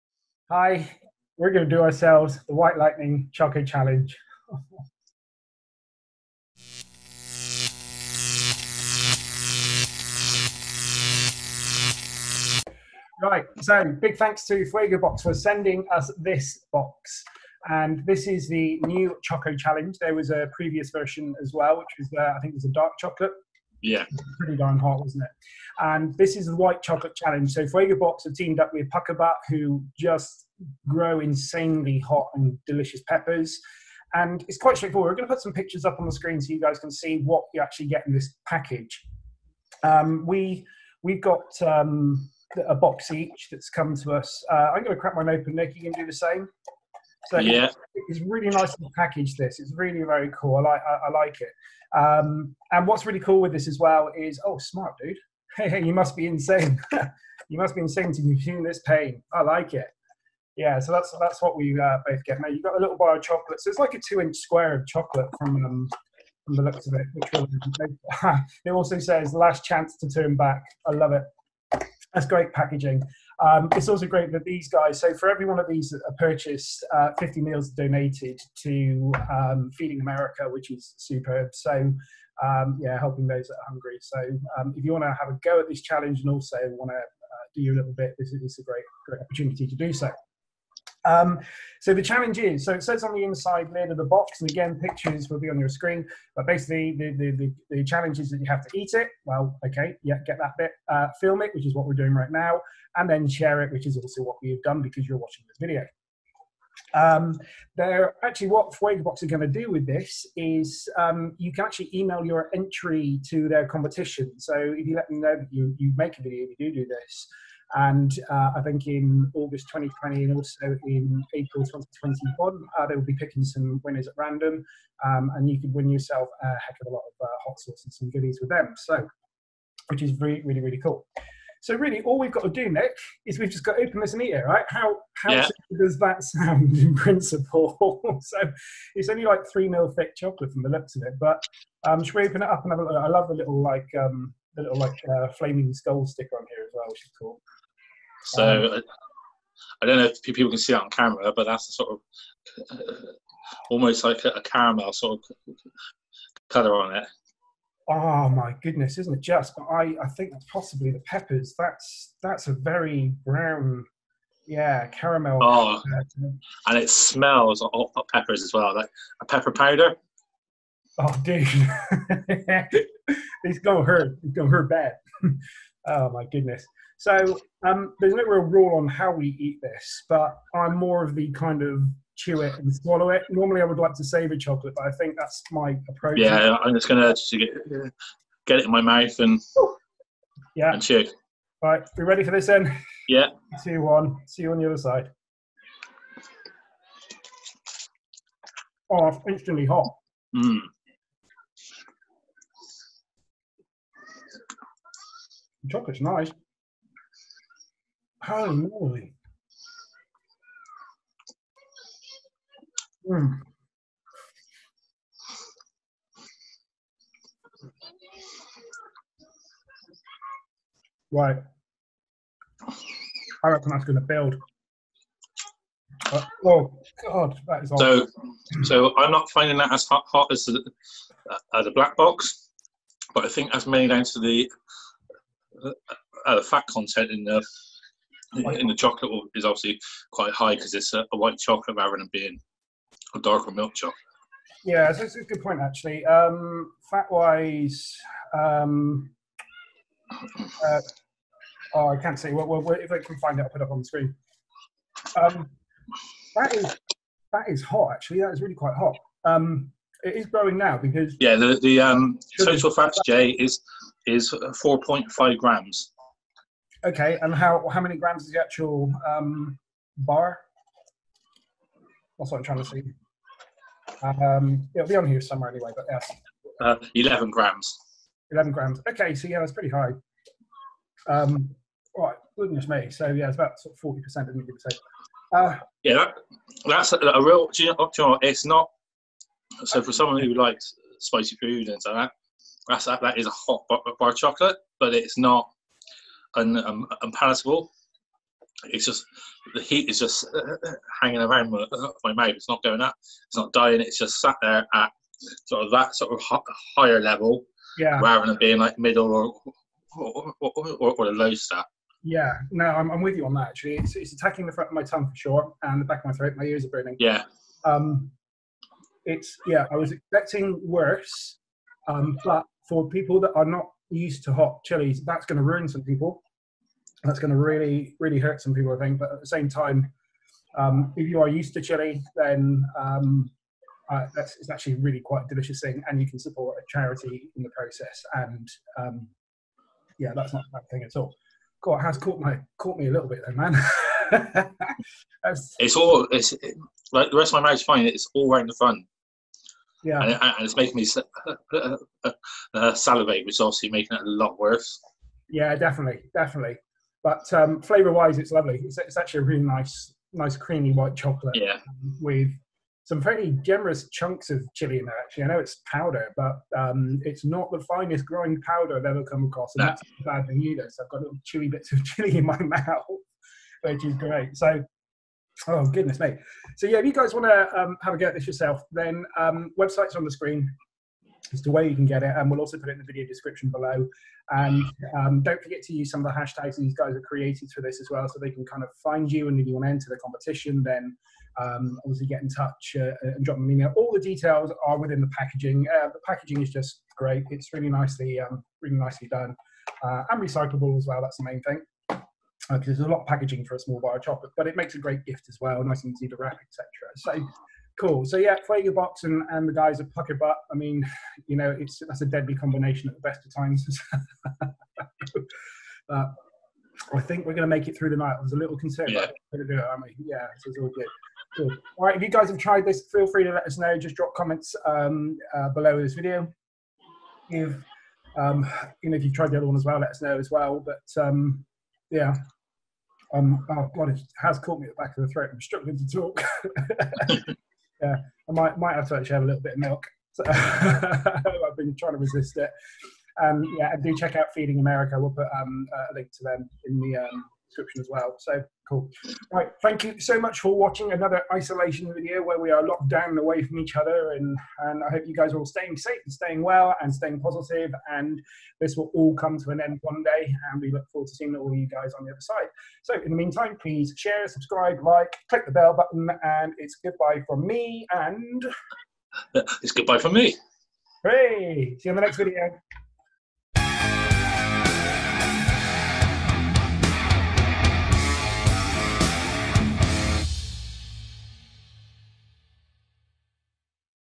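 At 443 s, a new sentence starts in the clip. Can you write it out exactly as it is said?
Um, yeah, and do check out Feeding America.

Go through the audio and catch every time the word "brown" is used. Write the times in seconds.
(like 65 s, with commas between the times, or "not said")
163 s.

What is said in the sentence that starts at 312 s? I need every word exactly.
Yeah, no, I'm, I'm with you on that.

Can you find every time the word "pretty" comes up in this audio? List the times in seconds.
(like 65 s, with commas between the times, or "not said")
24 s, 279 s.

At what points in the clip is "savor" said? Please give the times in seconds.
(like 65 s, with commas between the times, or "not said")
184 s.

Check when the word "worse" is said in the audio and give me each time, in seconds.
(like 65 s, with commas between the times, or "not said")
320 s, 354 s.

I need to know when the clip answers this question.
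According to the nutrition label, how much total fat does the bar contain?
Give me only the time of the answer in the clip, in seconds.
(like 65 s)
264 s.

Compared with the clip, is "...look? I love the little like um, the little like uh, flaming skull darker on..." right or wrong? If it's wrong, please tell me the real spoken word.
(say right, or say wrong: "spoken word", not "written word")
wrong: "sticker", not "darker".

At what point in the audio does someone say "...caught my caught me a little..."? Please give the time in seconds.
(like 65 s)
341 s.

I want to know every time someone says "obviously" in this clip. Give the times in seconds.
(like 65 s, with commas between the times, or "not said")
239 s, 353 s, 391 s.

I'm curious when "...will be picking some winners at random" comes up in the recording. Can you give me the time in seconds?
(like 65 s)
122 s.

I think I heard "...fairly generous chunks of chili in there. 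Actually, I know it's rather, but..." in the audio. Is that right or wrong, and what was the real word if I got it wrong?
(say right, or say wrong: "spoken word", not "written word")
wrong: "powder", not "rather".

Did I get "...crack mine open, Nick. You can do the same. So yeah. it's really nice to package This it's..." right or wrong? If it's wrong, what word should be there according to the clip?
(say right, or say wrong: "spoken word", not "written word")
right.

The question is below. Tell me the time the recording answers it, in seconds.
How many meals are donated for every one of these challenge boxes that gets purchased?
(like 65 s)
77 s.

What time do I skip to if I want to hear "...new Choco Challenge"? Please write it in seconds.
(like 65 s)
18 s.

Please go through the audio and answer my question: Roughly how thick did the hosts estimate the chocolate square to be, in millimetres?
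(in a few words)
3.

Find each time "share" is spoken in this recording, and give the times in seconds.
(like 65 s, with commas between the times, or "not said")
103 s, 463 s.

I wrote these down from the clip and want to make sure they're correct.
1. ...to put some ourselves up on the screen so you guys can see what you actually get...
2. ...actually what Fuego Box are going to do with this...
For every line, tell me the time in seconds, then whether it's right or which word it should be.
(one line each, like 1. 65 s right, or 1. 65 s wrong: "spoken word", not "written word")
1. 35 s wrong: "pictures", not "ourselves"
2. 108 s right.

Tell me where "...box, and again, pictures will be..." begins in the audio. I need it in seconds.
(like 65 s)
94 s.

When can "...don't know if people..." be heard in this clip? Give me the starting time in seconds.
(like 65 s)
149 s.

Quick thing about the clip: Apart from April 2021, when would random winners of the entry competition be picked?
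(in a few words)
August 2020.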